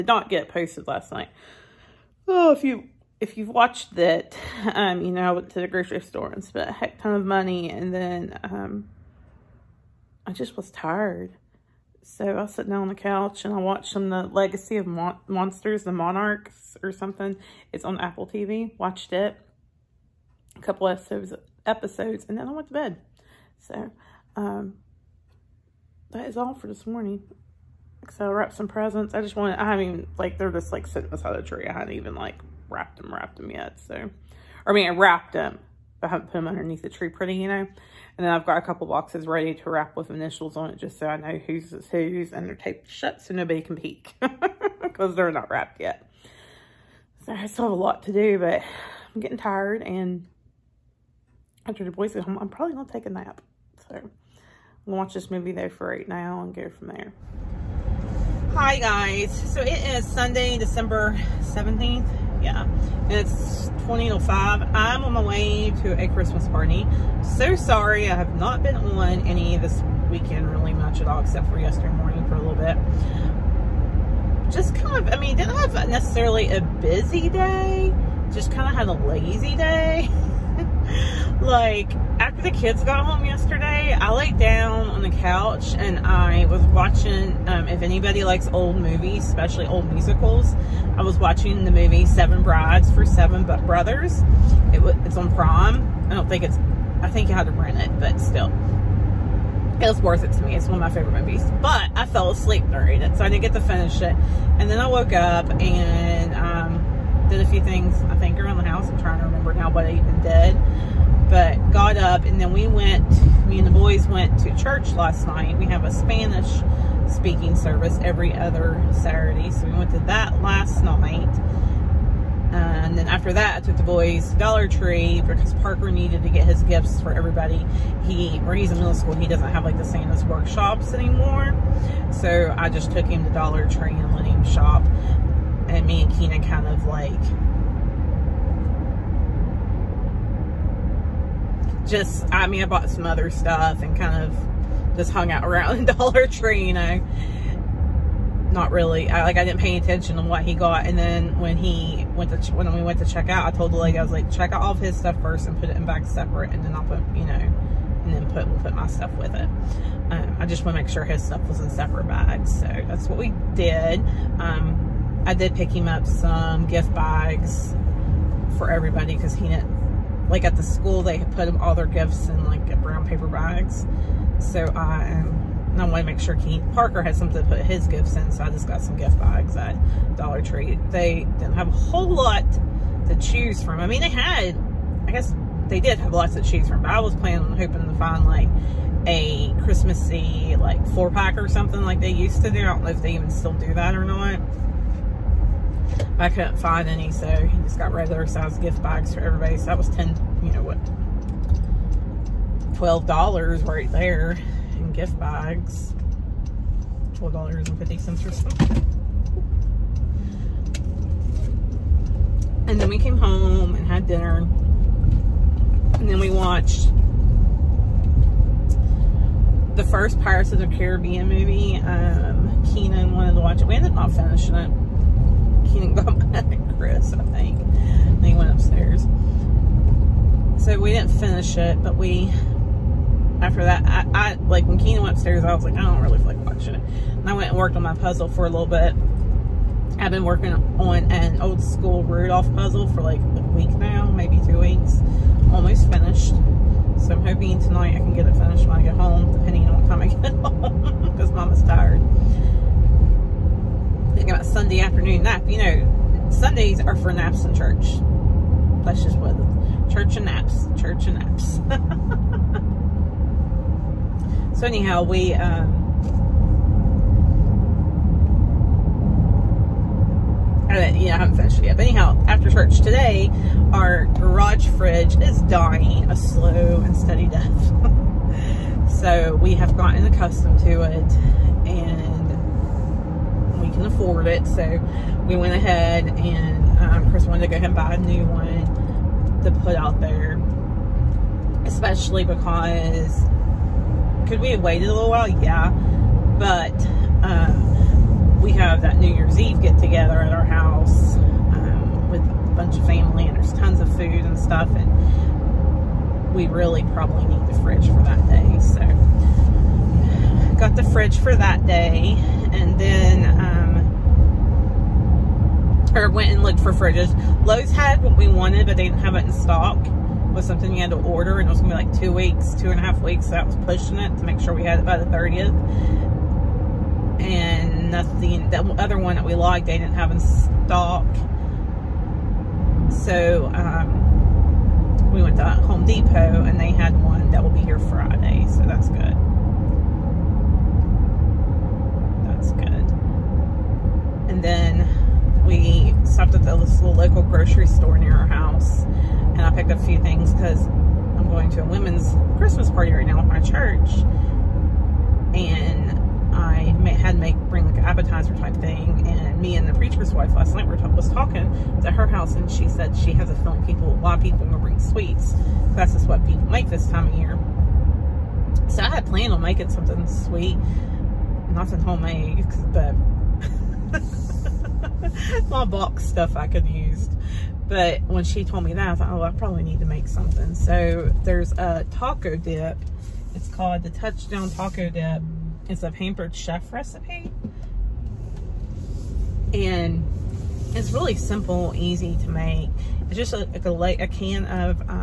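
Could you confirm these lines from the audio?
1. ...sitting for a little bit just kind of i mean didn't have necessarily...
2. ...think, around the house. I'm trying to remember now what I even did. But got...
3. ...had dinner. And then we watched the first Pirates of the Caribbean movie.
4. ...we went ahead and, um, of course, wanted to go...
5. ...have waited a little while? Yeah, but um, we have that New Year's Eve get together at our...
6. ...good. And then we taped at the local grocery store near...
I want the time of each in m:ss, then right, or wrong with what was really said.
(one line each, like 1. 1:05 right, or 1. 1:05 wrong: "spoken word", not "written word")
1. 1:11 wrong: "morning", not "sitting"
2. 1:48 right
3. 3:33 right
4. 4:45 right
5. 4:54 right
6. 5:42 wrong: "stopped", not "taped".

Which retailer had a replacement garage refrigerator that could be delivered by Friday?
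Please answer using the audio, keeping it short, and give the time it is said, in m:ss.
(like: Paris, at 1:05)
Home Depot, at 5:35.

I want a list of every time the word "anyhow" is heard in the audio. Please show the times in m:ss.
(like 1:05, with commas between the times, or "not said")
4:24, 4:31.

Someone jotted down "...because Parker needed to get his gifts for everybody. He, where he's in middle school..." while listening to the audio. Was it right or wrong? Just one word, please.
right.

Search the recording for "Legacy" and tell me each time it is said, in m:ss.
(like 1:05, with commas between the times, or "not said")
0:14.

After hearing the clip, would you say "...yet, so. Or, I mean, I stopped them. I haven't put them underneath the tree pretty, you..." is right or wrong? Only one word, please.
wrong.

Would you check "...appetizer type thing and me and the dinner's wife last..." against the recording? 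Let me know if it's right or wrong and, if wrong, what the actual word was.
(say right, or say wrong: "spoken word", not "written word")
wrong: "preacher", not "dinner".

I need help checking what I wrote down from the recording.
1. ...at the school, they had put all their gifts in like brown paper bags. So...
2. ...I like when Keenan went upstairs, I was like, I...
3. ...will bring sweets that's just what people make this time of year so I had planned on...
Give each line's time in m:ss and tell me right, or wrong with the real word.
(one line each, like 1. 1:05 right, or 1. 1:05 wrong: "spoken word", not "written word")
1. 2:50 right
2. 3:54 right
3. 6:04 right.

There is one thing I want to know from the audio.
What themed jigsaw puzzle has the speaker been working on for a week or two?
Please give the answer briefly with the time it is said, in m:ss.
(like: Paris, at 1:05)
Rudolph, at 4:02.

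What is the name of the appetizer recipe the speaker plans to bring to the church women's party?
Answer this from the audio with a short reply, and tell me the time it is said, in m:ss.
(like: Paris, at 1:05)
Touchdown Taco Dip, at 6:23.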